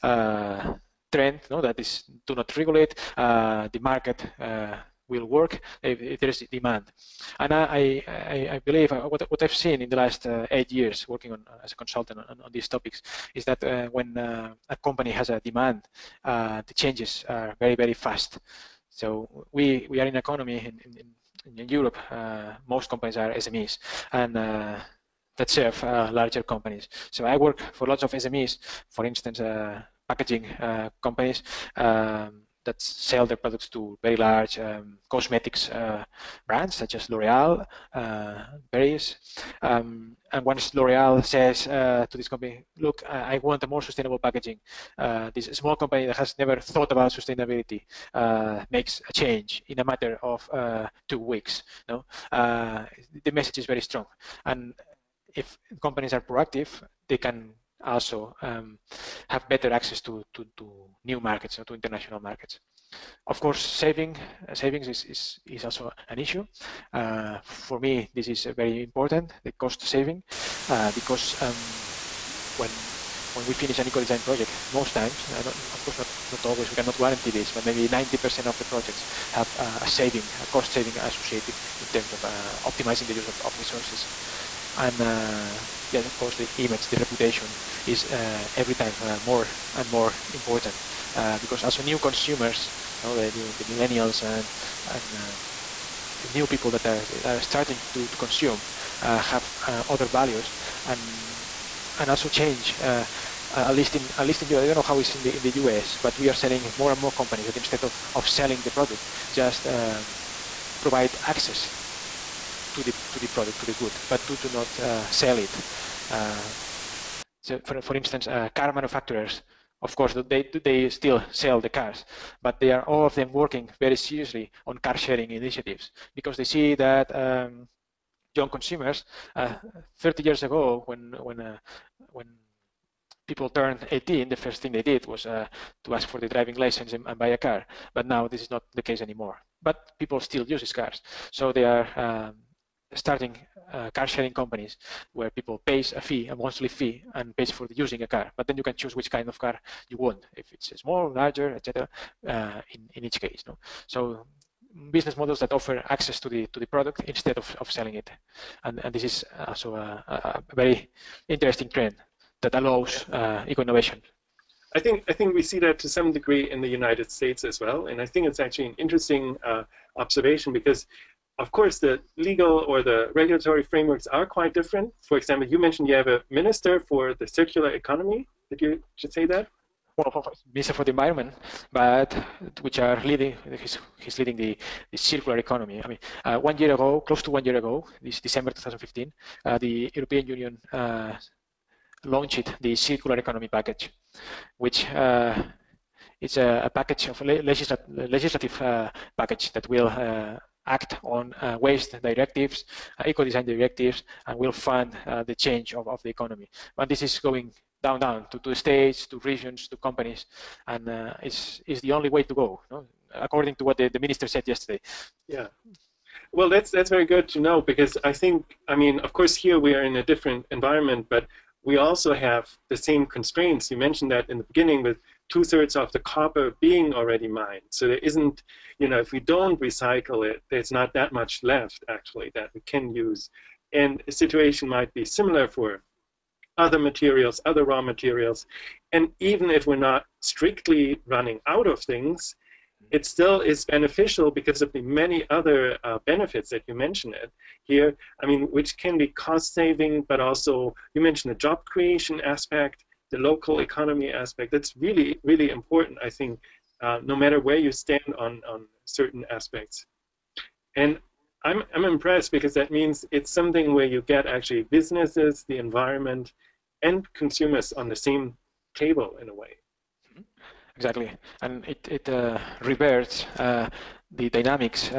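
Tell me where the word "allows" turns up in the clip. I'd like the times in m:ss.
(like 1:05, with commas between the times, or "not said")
2:42.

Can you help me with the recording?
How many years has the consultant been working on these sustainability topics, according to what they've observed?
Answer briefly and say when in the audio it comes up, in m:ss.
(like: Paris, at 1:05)
8, at 0:10.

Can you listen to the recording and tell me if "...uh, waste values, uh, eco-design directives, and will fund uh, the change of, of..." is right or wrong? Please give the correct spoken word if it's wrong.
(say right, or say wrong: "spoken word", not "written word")
wrong: "directives", not "values".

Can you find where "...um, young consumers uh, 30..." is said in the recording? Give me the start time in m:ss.
2:07.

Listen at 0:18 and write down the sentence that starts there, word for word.
So we we are in an economy in, in, in Europe, most companies are SMEs.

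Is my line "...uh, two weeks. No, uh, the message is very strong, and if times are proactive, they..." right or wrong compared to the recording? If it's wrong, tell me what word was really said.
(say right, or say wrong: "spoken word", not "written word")
wrong: "companies", not "times".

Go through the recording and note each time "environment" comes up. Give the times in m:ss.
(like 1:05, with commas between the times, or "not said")
3:00, 3:40, 4:25.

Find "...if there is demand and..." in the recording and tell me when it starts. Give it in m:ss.
0:06.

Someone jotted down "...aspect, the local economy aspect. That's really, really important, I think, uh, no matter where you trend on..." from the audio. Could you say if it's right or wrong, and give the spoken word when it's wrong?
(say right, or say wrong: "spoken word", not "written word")
wrong: "stand", not "trend".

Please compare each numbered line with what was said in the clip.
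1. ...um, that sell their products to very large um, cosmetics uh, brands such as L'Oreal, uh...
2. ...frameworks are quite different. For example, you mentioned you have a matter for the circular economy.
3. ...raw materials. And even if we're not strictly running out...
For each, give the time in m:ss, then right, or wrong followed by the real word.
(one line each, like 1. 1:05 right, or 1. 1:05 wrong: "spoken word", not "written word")
1. 0:31 right
2. 2:53 wrong: "minister", not "matter"
3. 3:57 right.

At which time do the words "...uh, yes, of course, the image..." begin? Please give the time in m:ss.
1:25.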